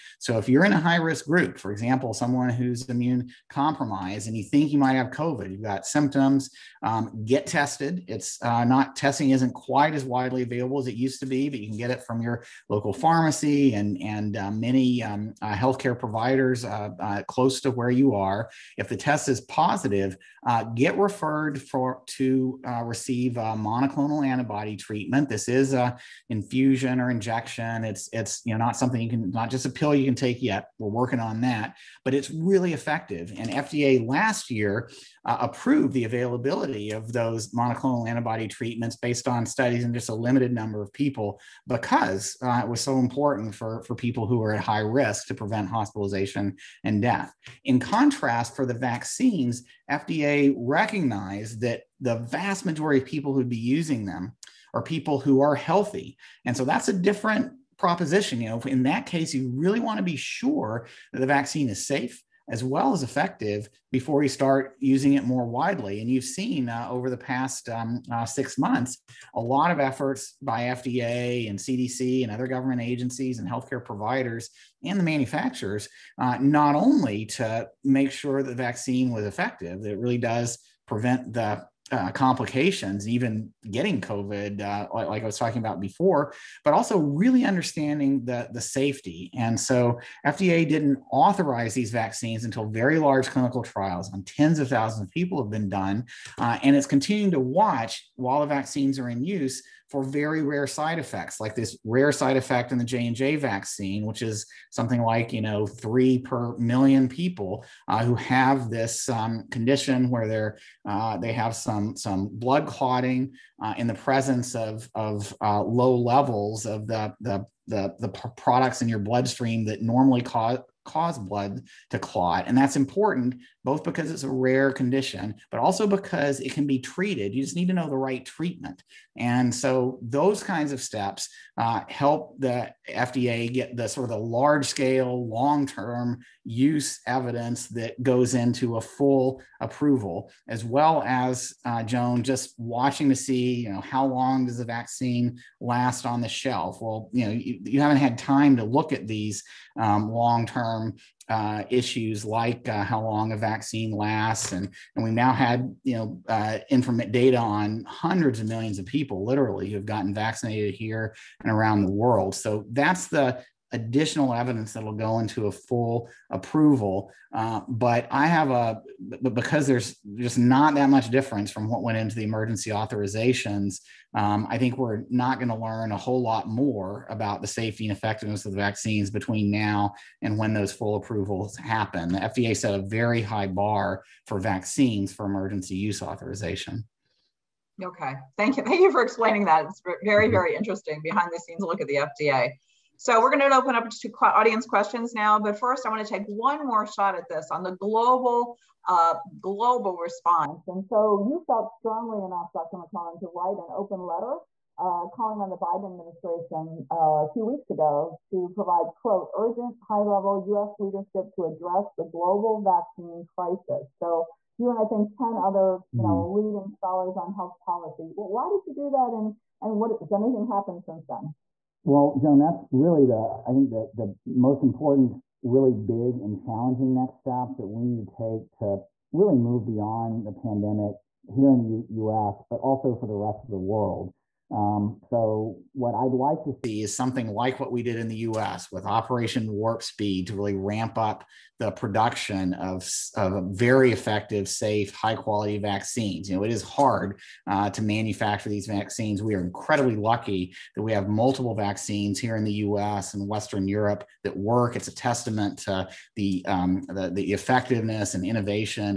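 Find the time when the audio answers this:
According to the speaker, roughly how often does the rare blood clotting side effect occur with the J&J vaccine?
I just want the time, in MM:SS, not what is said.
01:45.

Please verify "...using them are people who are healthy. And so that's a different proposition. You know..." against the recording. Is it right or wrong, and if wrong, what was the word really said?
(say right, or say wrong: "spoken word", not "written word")
right.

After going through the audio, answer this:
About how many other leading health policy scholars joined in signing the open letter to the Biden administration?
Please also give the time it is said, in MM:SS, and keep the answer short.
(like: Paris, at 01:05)
10, at 03:35.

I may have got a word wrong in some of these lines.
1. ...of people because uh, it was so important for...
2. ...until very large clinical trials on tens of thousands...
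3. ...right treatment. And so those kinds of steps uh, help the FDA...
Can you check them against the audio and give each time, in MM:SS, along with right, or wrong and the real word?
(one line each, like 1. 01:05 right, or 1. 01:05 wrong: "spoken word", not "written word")
1. 00:40 right
2. 01:32 right
3. 02:07 right.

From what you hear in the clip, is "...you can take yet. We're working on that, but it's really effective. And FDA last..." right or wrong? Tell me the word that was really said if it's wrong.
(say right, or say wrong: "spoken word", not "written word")
right.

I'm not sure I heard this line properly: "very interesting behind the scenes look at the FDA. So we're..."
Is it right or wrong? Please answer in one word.
right.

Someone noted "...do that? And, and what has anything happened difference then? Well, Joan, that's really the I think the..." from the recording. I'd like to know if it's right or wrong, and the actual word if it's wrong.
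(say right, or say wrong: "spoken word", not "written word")
wrong: "since", not "difference".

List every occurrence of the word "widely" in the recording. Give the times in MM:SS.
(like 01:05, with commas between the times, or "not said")
00:10, 01:05.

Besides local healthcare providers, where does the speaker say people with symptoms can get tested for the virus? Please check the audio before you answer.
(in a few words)
local pharmacy.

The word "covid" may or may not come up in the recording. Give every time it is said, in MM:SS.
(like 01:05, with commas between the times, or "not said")
00:05, 01:23.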